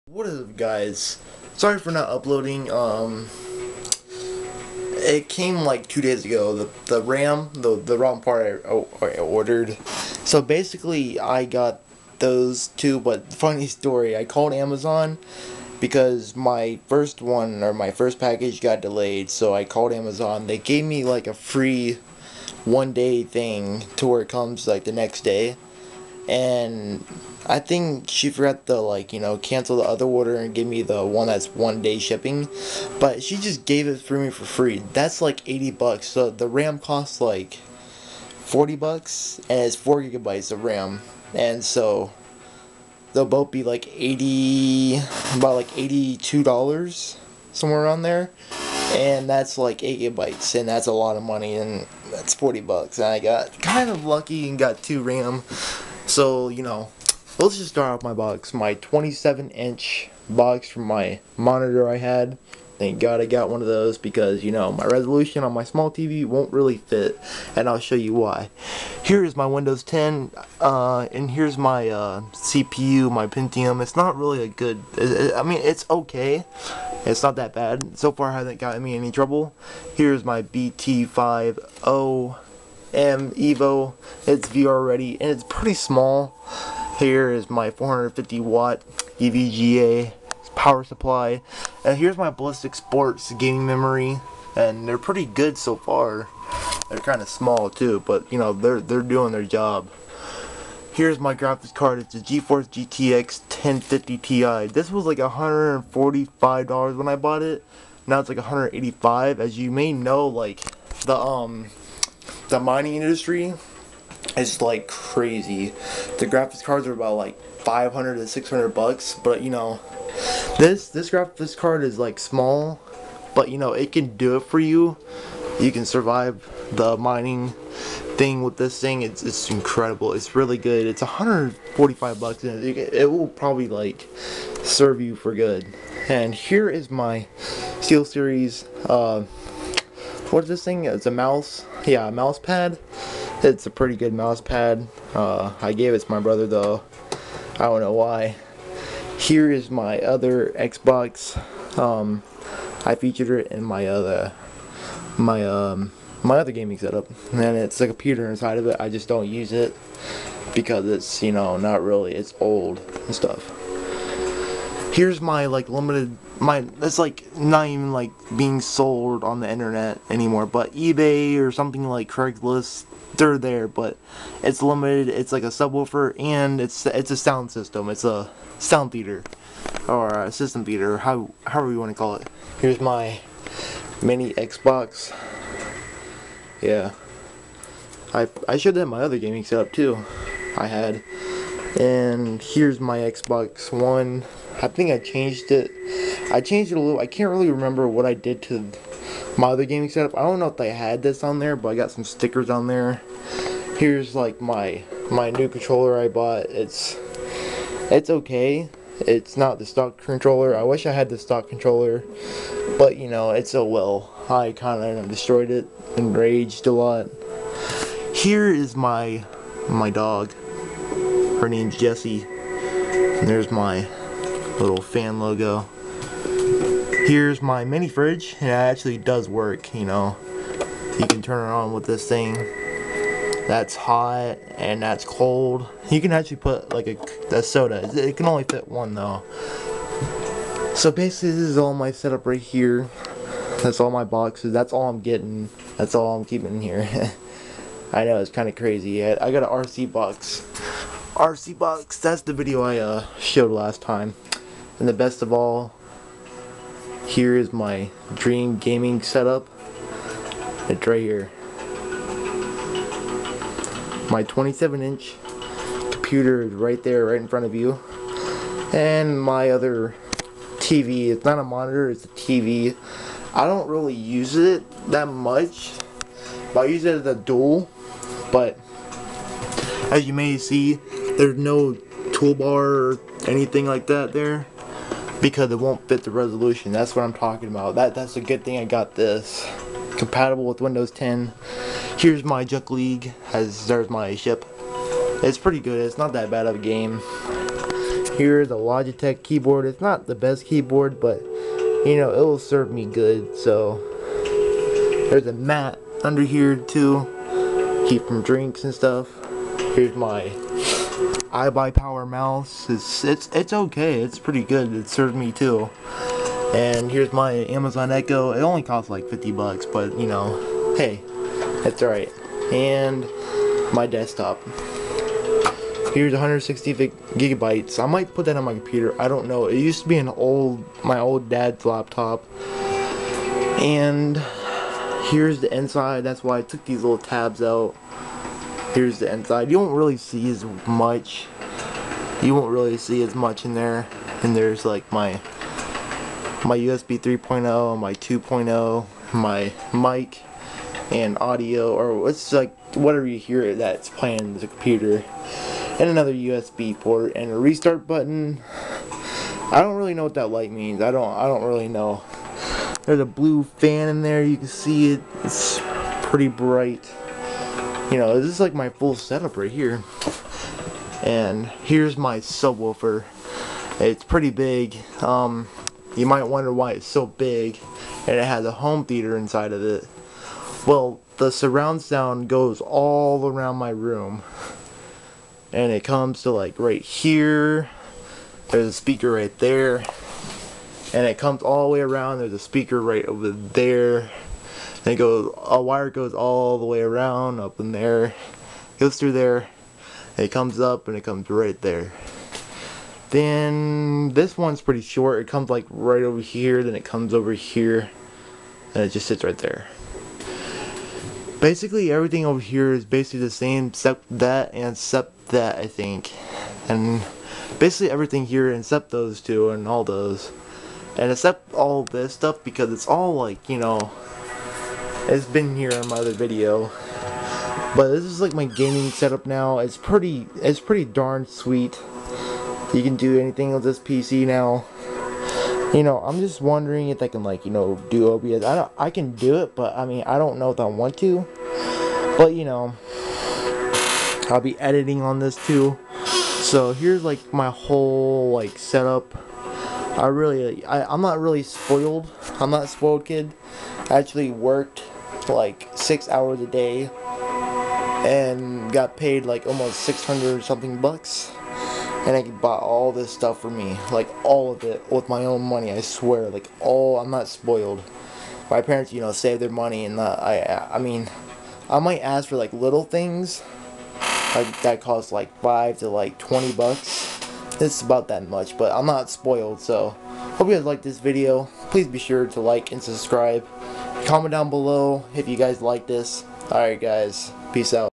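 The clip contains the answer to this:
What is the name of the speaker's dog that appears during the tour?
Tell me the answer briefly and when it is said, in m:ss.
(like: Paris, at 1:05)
Jessie, at 3:41.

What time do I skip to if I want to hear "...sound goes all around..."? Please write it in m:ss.
6:21.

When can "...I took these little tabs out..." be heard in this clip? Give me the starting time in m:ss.
5:36.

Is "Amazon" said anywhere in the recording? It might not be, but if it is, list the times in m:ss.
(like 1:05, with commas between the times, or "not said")
0:14, 0:19, 5:17.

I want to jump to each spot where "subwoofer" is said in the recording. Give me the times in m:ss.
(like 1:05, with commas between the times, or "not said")
2:55, 6:12.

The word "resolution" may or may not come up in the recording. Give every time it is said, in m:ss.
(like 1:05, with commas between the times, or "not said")
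1:04, 4:46.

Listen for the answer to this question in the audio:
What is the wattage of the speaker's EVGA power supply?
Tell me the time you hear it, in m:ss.
1:27.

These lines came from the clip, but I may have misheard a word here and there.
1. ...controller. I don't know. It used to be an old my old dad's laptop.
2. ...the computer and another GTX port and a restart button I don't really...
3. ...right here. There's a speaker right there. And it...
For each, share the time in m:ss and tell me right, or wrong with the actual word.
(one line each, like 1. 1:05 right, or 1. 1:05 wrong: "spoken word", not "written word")
1. 5:28 wrong: "computer", not "controller"
2. 5:54 wrong: "USB", not "GTX"
3. 6:26 right.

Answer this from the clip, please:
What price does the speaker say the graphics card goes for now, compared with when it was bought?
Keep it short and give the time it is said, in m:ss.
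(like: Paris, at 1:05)
$185, at 1:48.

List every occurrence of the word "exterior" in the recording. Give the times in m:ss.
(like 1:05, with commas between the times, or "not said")
not said.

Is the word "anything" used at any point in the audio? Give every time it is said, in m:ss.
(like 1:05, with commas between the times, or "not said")
4:43, 7:13.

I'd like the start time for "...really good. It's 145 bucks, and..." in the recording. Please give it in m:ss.
2:10.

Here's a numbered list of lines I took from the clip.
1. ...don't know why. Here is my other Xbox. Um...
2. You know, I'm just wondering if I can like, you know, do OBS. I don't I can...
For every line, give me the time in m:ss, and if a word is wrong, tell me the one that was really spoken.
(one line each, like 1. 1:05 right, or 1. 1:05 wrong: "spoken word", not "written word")
1. 2:27 right
2. 7:15 right.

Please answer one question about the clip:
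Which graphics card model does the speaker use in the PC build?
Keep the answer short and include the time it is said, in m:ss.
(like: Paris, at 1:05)
GeForce GTX 1050 Ti, at 1:42.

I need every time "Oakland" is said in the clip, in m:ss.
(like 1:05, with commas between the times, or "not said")
not said.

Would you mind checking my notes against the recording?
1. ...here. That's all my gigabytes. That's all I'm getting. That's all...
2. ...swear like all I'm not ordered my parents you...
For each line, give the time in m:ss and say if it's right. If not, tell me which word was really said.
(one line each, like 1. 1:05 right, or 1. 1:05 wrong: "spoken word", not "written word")
1. 4:02 wrong: "boxes", not "gigabytes"
2. 7:45 wrong: "spoiled", not "ordered".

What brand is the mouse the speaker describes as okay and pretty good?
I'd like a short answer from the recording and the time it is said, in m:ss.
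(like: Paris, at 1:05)
iBUYPOWER, at 5:11.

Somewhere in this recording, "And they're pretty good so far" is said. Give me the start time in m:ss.
1:34.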